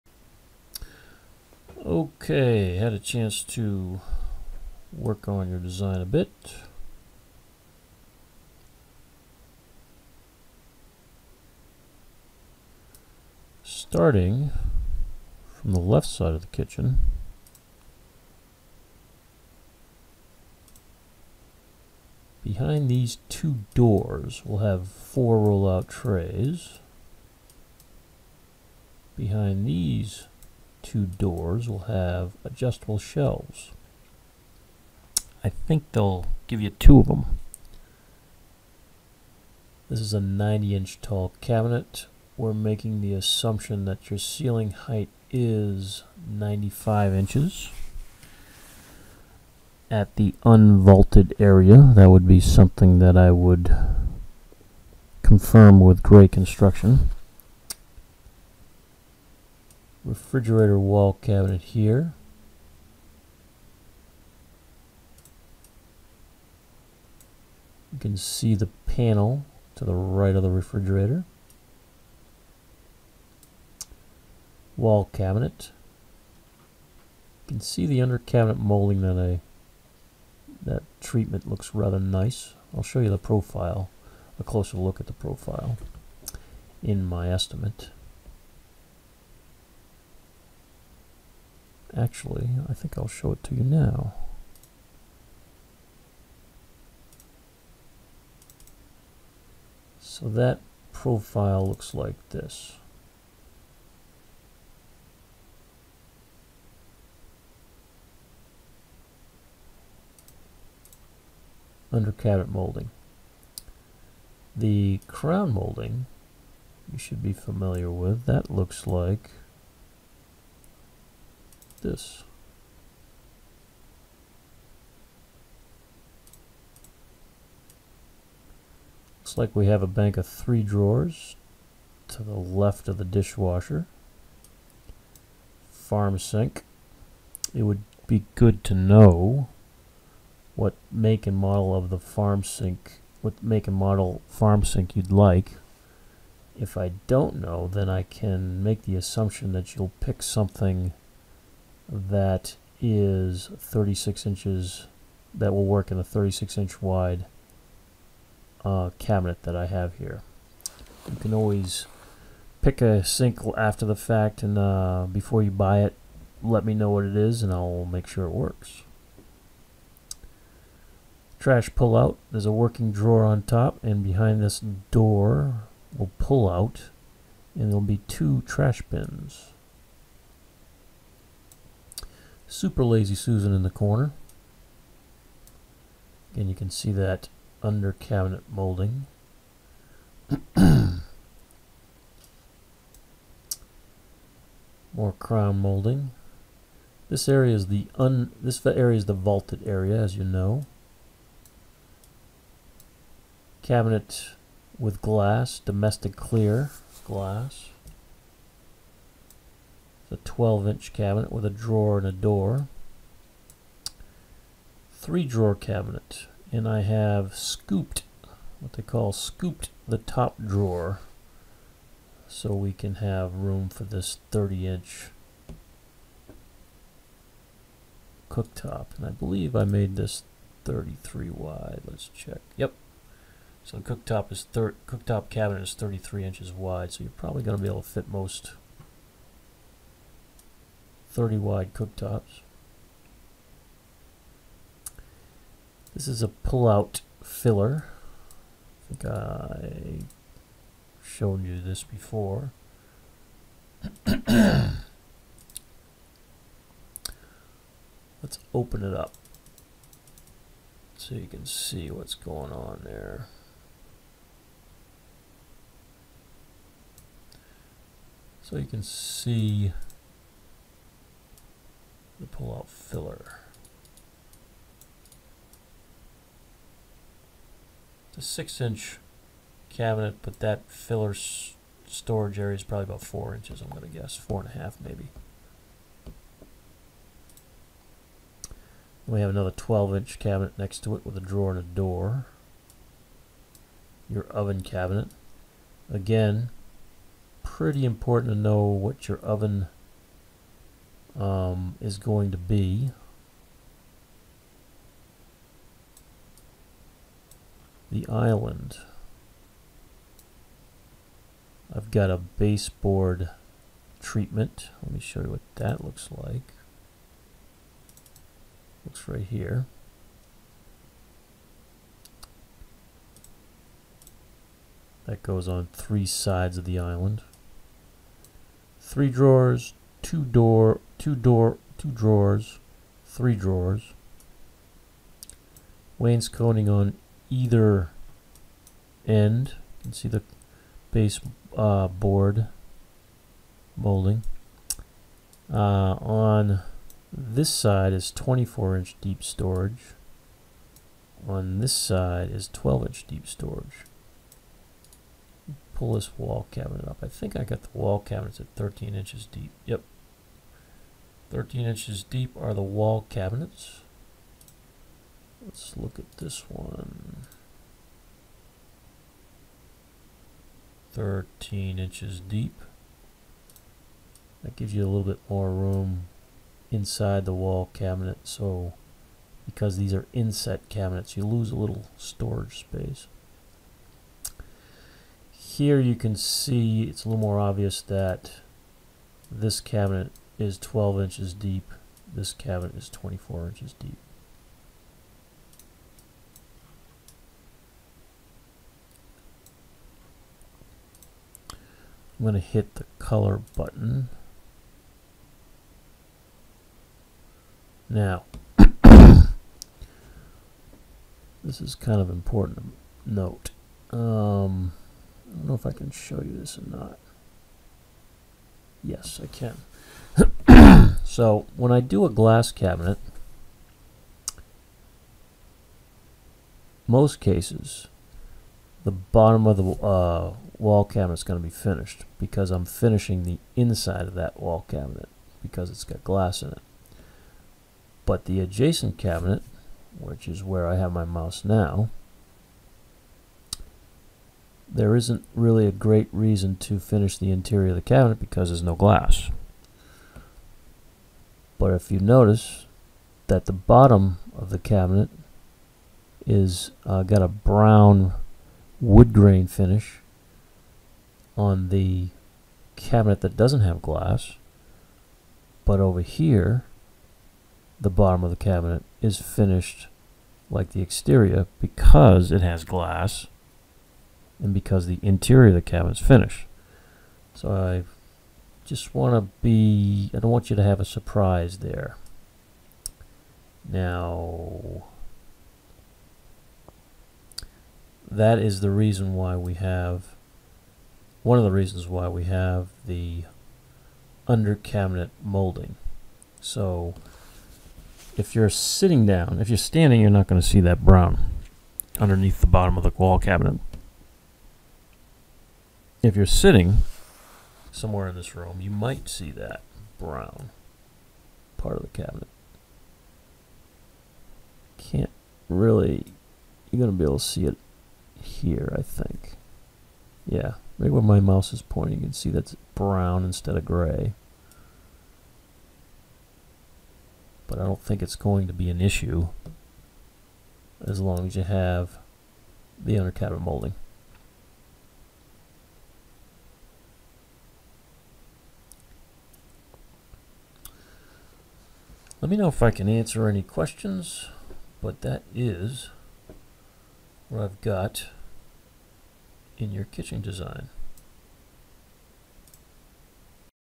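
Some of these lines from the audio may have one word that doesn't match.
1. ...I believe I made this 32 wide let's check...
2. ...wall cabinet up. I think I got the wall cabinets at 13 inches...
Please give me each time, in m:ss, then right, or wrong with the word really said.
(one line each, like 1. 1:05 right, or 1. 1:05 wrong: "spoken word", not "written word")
1. 3:49 wrong: "33", not "32"
2. 5:56 right.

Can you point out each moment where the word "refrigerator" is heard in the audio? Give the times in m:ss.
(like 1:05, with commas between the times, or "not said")
1:00, 1:10.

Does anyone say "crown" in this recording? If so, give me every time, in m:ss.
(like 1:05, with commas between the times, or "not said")
1:55, 3:15.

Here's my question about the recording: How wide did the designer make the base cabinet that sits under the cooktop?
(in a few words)
33 inches.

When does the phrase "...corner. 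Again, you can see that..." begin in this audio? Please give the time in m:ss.
3:03.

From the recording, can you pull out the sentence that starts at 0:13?
Starting from the left side of the kitchen.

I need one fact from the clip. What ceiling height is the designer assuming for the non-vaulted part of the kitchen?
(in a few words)
95 inches.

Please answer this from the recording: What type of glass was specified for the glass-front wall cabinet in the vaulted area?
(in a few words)
domestic clear glass.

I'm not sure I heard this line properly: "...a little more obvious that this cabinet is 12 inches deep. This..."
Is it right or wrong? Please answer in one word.
right.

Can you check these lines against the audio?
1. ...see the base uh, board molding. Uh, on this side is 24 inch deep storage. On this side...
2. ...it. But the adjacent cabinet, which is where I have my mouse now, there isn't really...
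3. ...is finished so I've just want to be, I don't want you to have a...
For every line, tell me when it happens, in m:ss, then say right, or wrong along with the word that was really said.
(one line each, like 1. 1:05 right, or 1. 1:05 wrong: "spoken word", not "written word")
1. 5:39 right
2. 7:16 right
3. 7:56 right.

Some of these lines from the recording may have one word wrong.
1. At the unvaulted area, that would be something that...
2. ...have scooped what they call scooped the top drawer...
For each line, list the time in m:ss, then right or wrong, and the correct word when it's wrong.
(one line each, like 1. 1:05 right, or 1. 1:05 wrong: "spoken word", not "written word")
1. 0:49 right
2. 3:36 right.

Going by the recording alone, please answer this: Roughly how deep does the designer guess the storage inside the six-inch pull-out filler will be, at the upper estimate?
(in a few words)
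4.5 inches.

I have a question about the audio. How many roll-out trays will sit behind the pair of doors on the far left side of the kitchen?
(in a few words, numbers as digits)
4.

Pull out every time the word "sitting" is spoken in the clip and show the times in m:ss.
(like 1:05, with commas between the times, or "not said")
8:18, 8:26.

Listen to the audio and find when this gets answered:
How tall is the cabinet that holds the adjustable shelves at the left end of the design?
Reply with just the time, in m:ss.
0:40.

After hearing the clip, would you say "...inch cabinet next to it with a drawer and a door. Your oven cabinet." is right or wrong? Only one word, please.
right.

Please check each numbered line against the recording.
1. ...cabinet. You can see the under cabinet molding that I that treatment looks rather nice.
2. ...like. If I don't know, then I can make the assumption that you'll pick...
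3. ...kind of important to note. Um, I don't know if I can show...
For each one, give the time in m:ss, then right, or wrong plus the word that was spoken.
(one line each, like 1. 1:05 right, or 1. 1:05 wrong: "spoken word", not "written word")
1. 1:15 right
2. 2:25 right
3. 6:51 right.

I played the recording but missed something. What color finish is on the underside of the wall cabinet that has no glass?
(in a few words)
brown wood grain.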